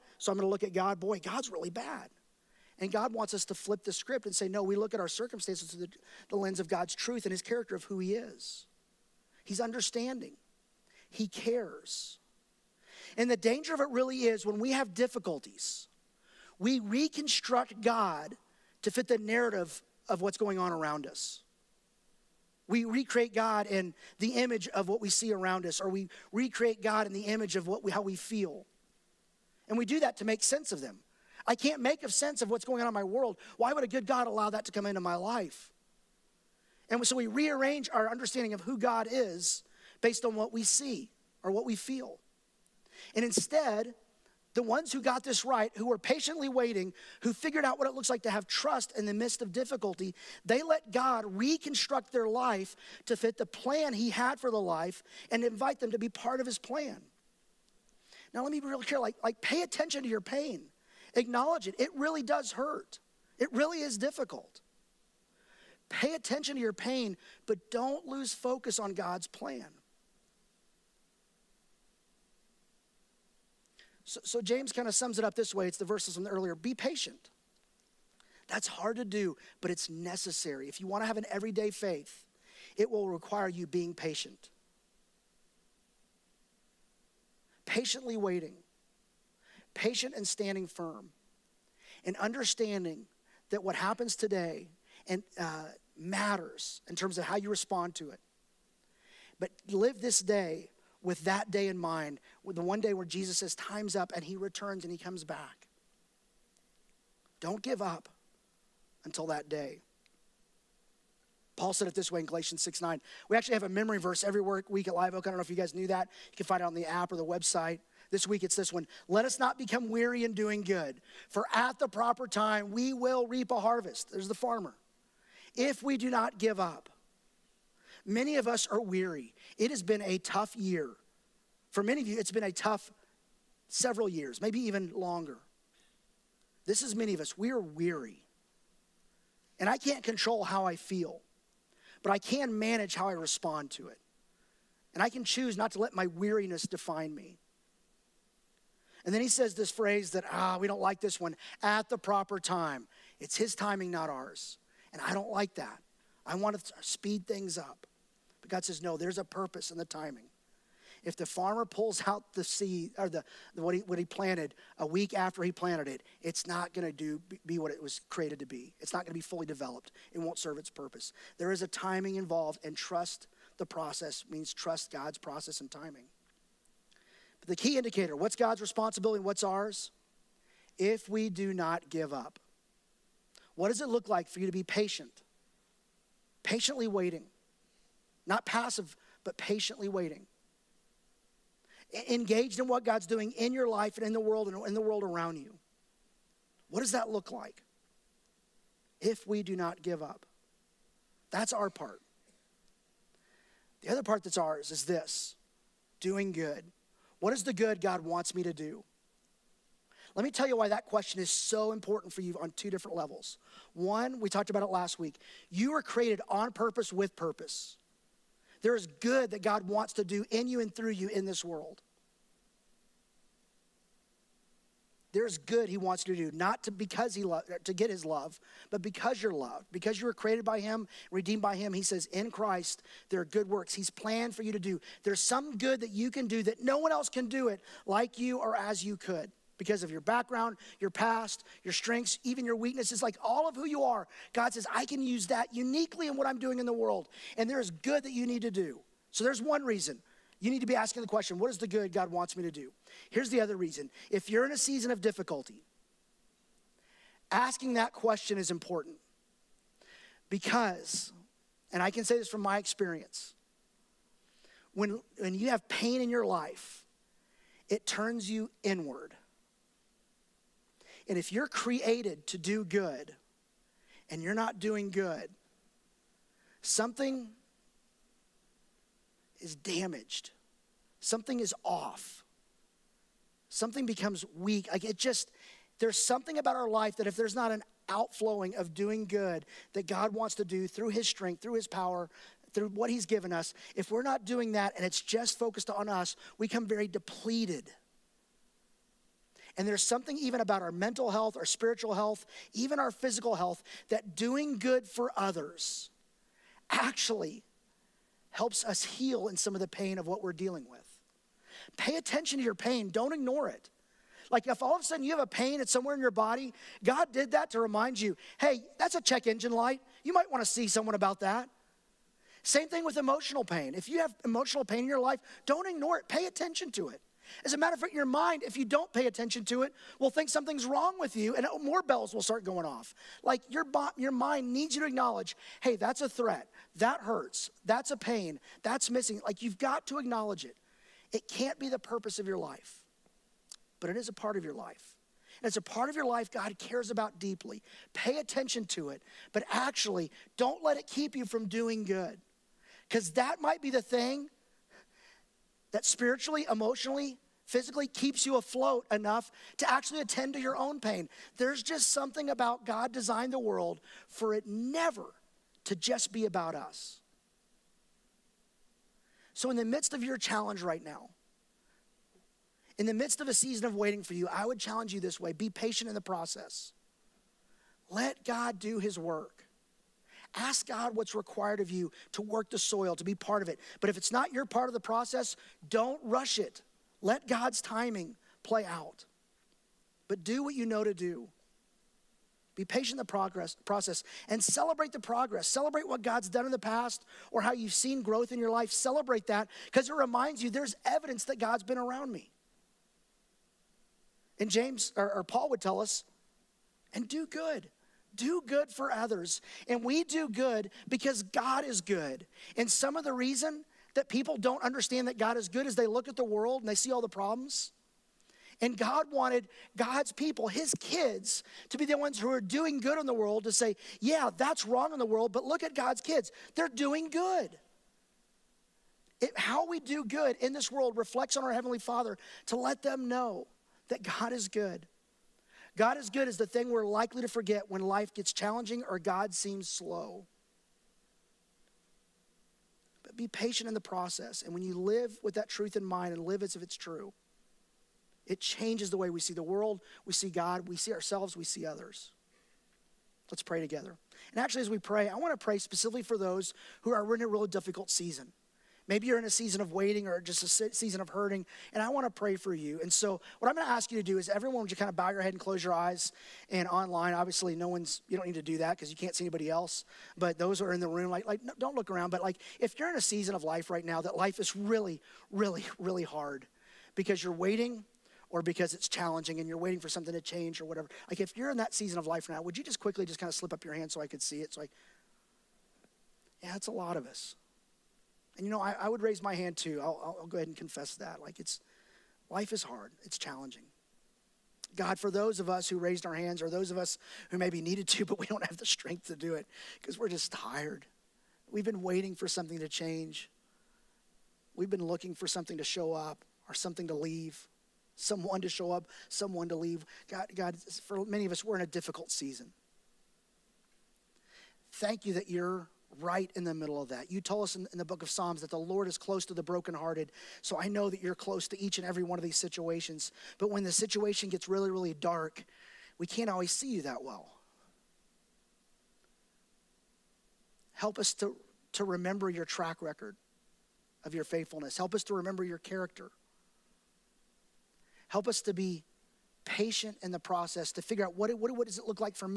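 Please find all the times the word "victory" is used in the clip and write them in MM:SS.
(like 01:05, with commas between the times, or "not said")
not said.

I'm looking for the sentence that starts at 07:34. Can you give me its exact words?
And actually, as we pray, I want to pray specifically for those who are in a really difficult season.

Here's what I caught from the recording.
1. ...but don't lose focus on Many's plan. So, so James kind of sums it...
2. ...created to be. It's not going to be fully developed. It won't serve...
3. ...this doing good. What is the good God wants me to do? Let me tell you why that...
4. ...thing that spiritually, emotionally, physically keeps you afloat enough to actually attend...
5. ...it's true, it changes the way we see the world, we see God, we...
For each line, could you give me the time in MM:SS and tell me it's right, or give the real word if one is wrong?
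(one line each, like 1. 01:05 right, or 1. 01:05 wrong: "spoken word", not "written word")
1. 01:07 wrong: "God", not "Many"
2. 02:48 right
3. 03:24 right
4. 05:53 right
5. 07:26 right.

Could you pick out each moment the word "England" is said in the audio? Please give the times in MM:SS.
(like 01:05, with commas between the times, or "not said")
not said.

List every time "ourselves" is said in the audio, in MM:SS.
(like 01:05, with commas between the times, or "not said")
07:30.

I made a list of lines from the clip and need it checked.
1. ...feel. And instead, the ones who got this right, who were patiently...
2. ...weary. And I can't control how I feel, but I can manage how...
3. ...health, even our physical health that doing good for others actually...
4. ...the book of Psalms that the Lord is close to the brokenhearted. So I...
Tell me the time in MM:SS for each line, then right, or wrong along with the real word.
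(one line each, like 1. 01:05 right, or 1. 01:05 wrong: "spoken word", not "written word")
1. 00:41 right
2. 02:17 right
3. 05:01 right
4. 08:37 right.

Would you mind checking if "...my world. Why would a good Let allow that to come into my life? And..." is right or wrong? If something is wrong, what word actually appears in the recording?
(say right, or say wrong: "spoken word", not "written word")
wrong: "God", not "Let".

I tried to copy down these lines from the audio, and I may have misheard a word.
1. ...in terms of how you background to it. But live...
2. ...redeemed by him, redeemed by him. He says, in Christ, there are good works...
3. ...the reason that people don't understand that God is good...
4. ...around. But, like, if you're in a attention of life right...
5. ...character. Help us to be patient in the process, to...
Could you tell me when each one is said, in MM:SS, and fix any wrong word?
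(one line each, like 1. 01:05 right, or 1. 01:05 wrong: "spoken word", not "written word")
1. 01:36 wrong: "respond", not "background"
2. 03:50 wrong: "created", not "redeemed"
3. 06:53 right
4. 07:51 wrong: "season", not "attention"
5. 08:55 right.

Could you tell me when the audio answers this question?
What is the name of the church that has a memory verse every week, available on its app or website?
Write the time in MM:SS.
01:54.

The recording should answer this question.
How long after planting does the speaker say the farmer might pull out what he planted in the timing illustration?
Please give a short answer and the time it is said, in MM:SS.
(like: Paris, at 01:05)
A week, at 02:44.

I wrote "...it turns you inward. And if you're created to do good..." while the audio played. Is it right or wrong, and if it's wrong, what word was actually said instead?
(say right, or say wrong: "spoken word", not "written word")
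right.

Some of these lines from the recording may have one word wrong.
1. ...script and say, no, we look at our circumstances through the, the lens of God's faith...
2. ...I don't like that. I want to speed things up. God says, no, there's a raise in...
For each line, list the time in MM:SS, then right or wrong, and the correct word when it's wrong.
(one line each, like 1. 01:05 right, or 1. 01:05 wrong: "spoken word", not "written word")
1. 00:03 wrong: "truth", not "faith"
2. 02:35 wrong: "purpose", not "raise".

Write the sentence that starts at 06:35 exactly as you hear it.
Celebrate what God's done in the past or how you've seen growth in your life.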